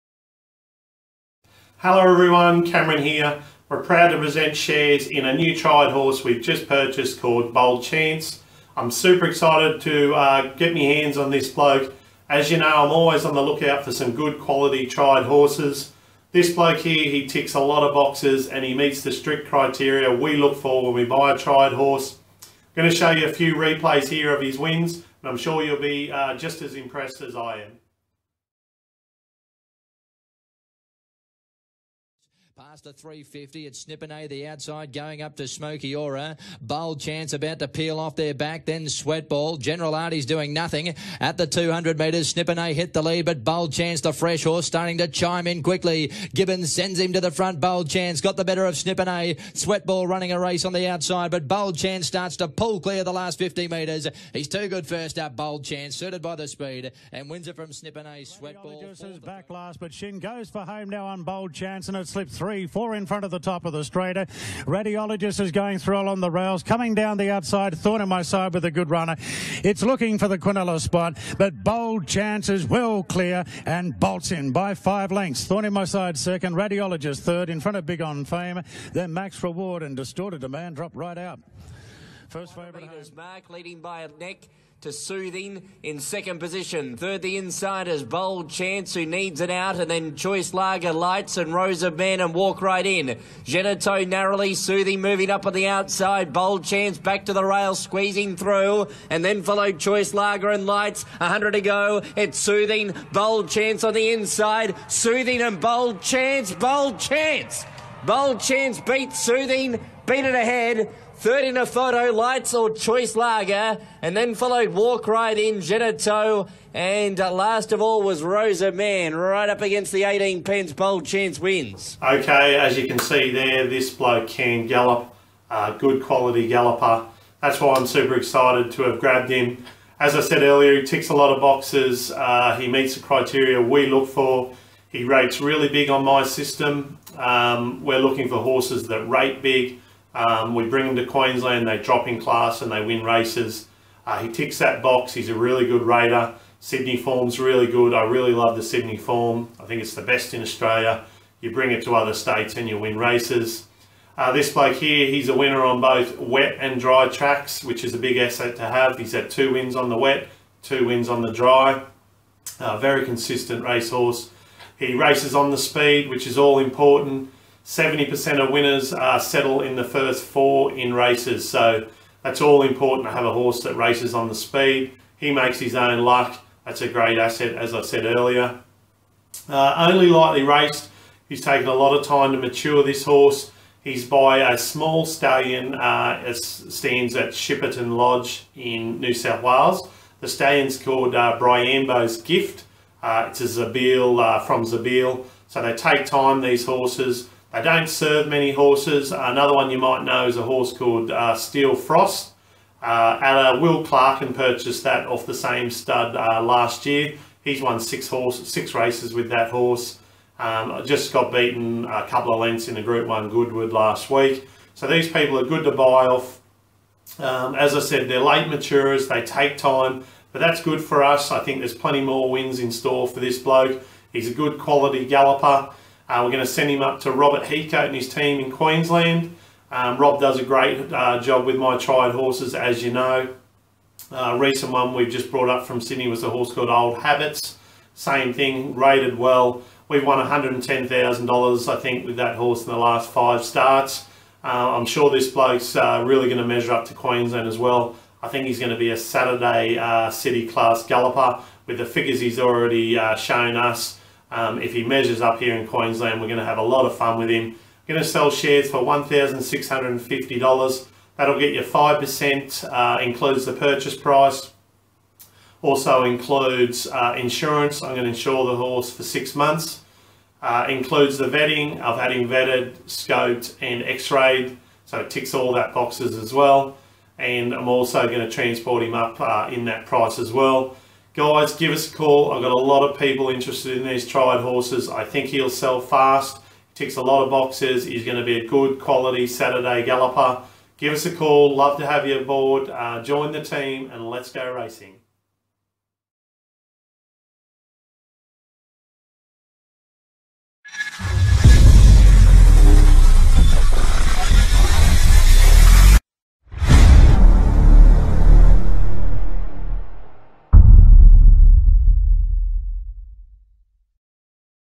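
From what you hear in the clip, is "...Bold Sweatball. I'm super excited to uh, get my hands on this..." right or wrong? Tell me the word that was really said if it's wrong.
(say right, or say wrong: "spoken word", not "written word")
wrong: "Chance", not "Sweatball".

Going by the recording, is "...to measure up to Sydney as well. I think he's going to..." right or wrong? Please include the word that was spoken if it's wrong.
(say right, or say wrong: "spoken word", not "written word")
wrong: "Queensland", not "Sydney".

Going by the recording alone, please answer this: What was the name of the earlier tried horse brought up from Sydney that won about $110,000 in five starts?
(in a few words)
Old Habits.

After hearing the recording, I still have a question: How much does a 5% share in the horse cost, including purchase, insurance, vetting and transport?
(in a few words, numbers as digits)
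$1,650.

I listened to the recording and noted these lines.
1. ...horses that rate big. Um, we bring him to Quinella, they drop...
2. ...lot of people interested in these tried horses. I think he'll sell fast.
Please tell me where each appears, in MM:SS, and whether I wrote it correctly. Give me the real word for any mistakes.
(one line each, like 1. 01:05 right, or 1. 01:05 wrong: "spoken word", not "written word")
1. 02:18 wrong: "Queensland", not "Quinella"
2. 04:42 right.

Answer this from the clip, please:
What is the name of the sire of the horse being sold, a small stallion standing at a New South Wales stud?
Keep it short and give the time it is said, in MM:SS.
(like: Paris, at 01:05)
Bryambo's Gift, at 03:11.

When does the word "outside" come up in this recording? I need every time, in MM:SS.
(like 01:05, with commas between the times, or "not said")
00:34, 00:50, 01:07, 01:35.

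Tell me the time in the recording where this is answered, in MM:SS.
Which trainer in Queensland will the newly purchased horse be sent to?
03:47.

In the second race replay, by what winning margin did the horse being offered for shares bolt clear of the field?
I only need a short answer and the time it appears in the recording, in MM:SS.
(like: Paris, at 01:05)
5 lengths, at 01:14.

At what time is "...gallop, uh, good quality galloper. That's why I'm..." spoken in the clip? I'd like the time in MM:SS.
02:04.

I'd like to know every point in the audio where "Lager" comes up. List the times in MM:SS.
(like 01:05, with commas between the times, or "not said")
01:30, 01:40, 01:53.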